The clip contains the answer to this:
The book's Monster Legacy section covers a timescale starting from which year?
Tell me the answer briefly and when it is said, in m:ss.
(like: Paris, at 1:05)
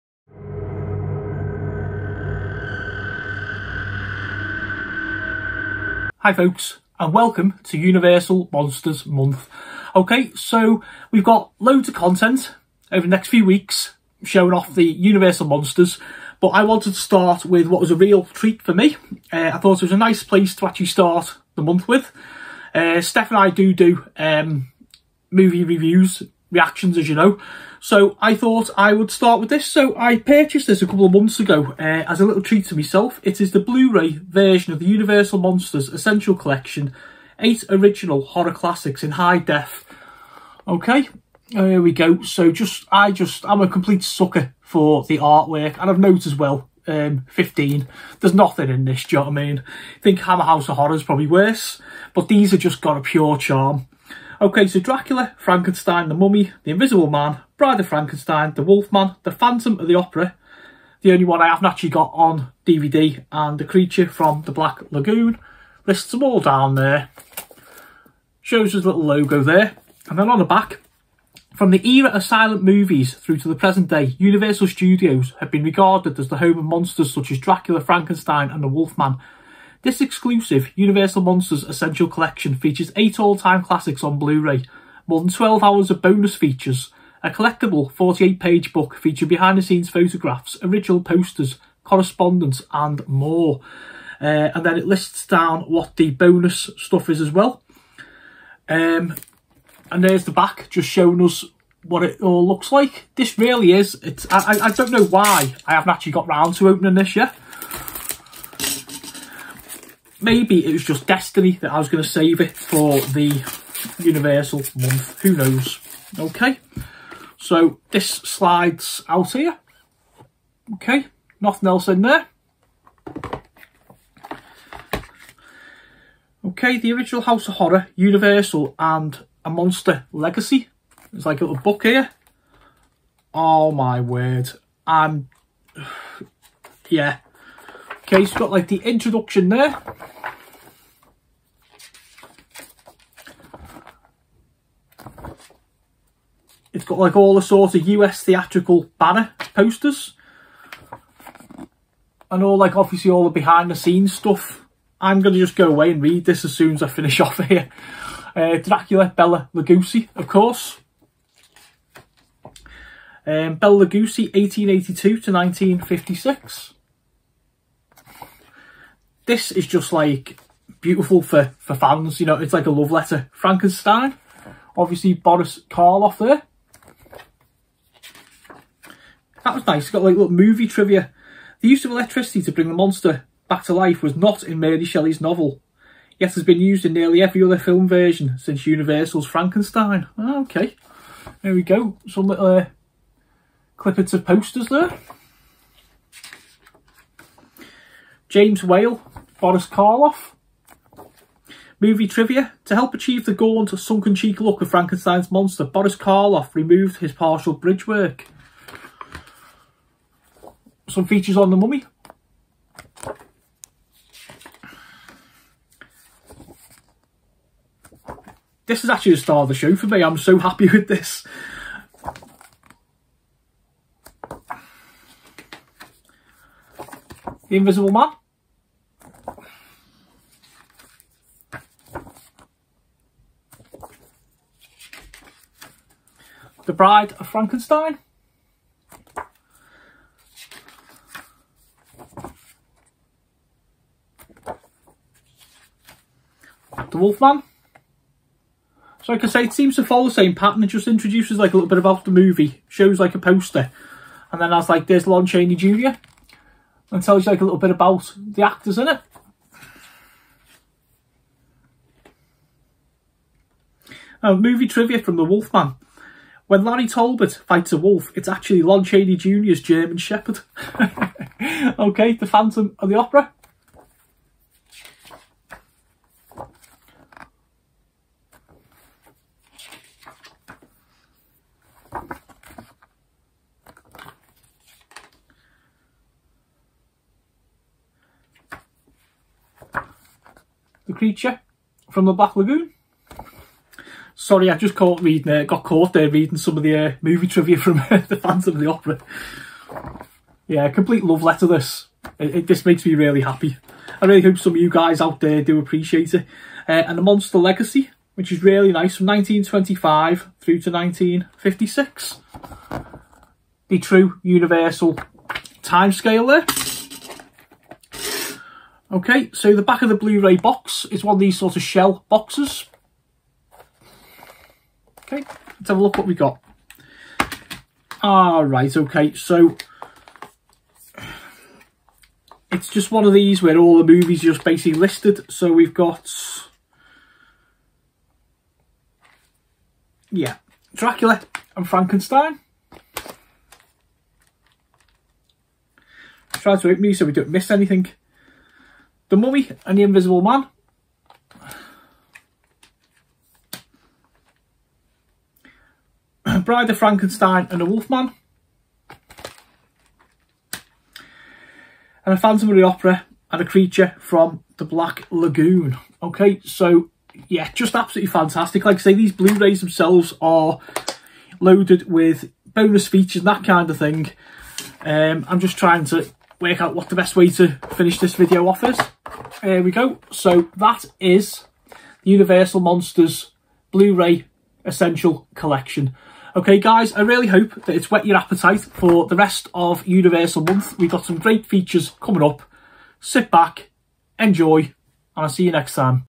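1925, at 5:08.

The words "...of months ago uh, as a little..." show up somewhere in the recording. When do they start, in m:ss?
0:31.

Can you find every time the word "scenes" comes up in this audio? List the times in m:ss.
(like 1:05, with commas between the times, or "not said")
1:29, 2:33.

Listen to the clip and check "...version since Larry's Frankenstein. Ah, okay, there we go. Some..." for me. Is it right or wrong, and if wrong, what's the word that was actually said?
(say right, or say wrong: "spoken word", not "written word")
wrong: "Universal", not "Larry".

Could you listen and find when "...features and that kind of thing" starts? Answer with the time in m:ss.
6:12.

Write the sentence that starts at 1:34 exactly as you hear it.
Uh, and then it lists down what the bonus stuff is as well.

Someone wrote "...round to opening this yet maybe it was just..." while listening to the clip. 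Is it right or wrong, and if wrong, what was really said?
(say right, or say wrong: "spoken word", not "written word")
right.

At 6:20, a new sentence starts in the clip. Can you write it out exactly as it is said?
So that is the Universal Monsters Blu-ray Essential Collection.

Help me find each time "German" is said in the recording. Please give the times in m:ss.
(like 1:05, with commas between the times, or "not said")
4:29.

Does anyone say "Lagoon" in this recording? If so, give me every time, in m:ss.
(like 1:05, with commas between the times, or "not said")
1:04, 4:52, 6:05.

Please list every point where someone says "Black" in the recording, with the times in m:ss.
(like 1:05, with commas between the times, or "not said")
1:04, 4:52, 6:04.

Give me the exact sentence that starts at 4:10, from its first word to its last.
It just introduces like a little bit about the movie, shows like a poster, and then has like there's Lon Chaney Jr.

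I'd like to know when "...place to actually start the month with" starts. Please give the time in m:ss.
0:20.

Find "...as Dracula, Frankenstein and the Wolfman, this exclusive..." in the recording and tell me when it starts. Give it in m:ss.
1:17.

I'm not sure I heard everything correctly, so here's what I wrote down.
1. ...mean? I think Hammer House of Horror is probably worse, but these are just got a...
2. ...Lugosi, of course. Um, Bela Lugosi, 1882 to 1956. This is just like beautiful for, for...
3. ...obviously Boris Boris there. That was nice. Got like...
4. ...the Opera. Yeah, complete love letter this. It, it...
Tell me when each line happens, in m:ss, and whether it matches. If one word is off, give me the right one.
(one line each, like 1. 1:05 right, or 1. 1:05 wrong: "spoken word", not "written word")
1. 0:49 right
2. 2:39 right
3. 2:54 wrong: "Karloff", not "Boris"
4. 4:58 right.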